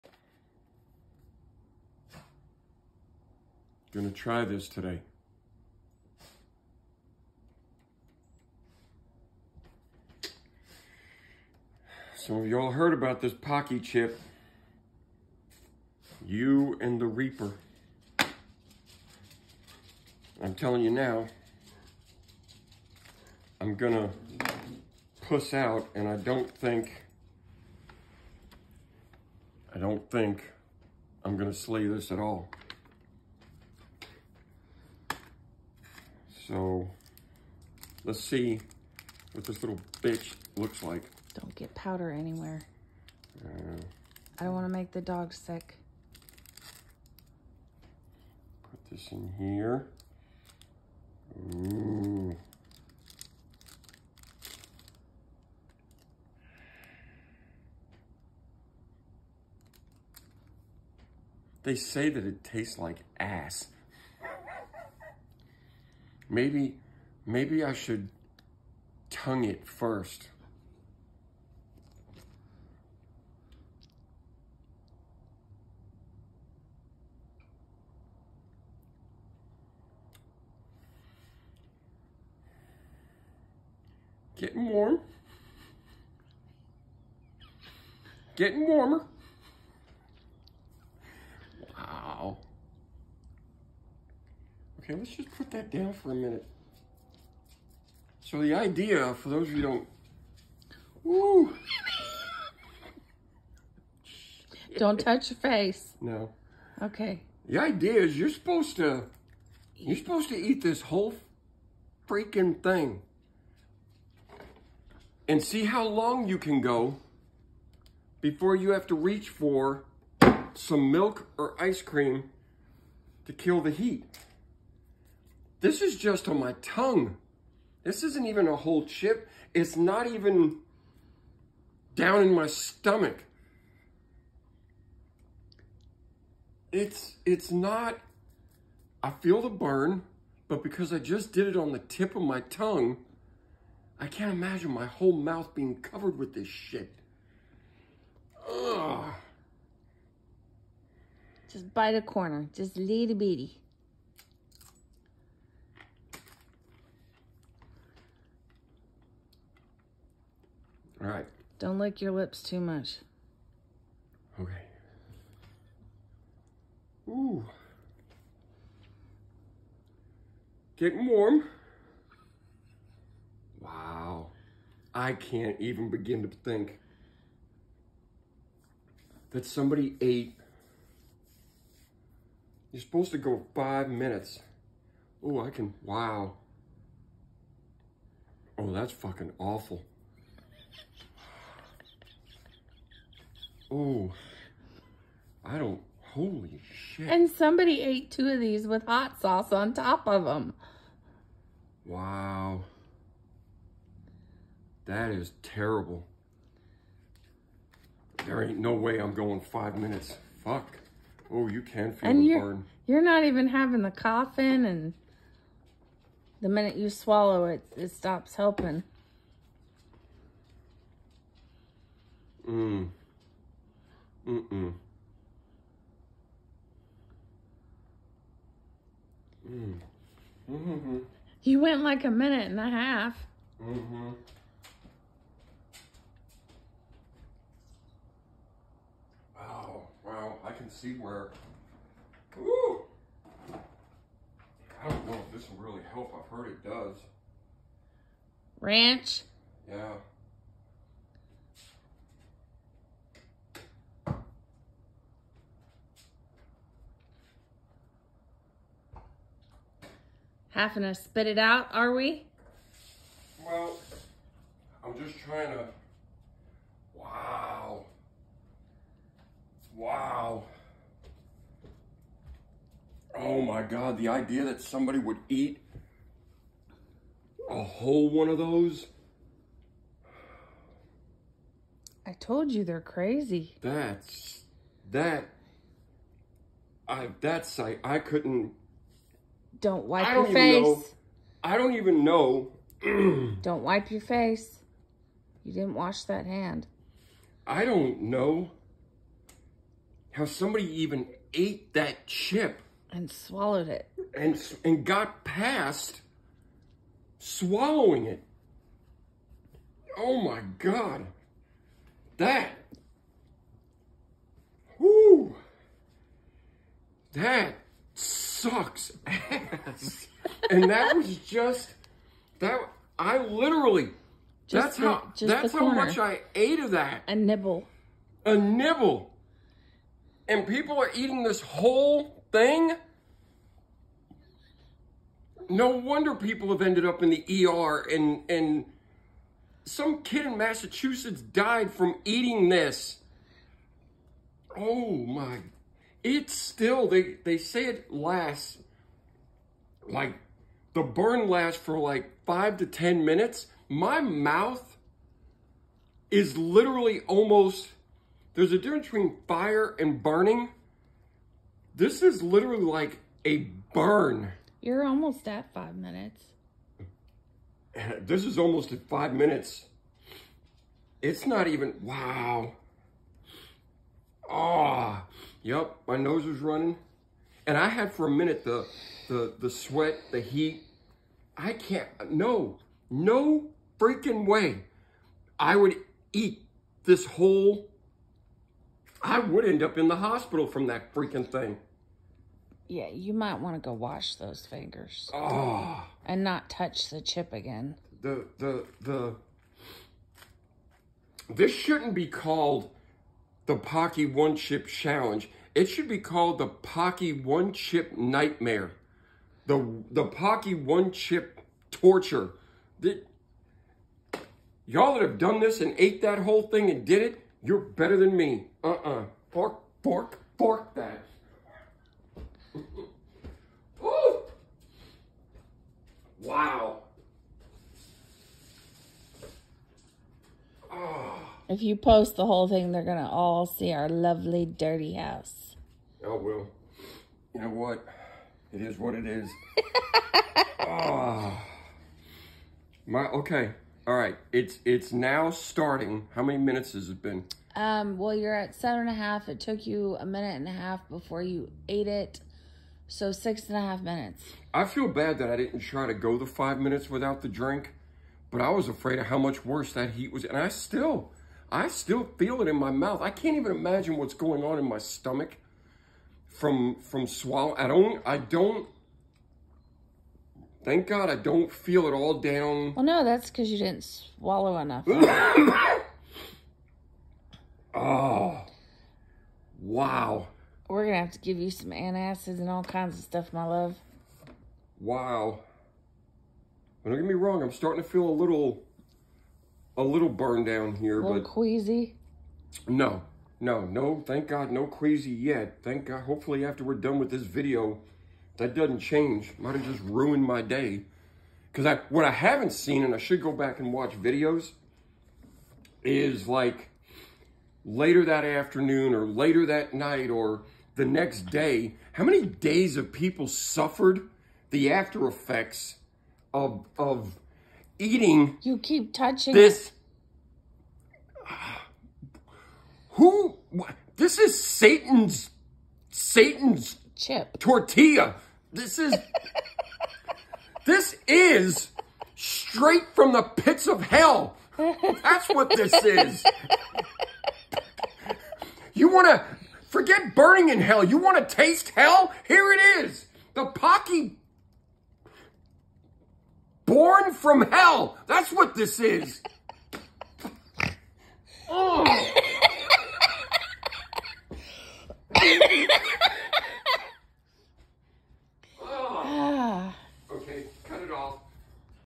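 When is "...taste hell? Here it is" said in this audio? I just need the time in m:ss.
9:01.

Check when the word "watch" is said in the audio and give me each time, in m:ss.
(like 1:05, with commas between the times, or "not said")
8:23.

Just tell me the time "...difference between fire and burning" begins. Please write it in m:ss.
5:58.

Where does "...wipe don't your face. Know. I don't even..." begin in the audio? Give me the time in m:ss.
4:49.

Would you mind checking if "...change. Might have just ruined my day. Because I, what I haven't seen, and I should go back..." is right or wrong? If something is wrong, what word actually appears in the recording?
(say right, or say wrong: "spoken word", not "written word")
right.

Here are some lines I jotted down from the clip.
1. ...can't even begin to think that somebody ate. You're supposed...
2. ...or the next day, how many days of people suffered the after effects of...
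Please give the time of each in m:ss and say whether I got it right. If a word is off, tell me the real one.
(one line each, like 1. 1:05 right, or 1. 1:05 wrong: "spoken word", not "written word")
1. 2:55 right
2. 8:30 right.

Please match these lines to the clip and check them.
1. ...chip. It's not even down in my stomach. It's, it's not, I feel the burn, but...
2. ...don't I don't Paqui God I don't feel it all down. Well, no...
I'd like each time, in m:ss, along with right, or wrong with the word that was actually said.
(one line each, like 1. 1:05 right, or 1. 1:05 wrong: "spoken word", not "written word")
1. 2:08 right
2. 7:47 wrong: "Thank", not "Paqui".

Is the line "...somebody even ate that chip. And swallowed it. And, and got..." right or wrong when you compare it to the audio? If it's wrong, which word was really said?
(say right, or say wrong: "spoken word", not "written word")
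right.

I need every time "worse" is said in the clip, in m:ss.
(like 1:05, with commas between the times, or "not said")
7:39.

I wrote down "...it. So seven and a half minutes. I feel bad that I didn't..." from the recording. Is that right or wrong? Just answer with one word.
wrong.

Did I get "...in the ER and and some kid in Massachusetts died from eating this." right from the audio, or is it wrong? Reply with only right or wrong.
right.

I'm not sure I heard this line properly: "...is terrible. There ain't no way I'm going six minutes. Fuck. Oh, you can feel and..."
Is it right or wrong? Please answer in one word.
wrong.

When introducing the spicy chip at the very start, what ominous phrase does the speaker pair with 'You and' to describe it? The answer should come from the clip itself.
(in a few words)
the Reaper.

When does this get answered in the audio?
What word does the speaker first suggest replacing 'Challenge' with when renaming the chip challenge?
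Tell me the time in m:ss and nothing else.
6:47.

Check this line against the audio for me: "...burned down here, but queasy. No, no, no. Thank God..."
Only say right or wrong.
right.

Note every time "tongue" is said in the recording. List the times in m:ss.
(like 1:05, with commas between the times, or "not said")
1:09, 2:06, 2:22.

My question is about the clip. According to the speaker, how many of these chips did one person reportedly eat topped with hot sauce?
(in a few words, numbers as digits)
2.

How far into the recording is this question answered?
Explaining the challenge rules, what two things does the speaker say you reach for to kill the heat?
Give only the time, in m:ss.
2:00.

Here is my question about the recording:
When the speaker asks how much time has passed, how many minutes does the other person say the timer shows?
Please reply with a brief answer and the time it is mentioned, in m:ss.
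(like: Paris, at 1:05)
7.5, at 7:28.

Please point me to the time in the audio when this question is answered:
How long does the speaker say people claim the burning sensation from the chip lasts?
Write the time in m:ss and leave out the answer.
5:52.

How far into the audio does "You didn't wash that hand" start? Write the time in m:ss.
4:55.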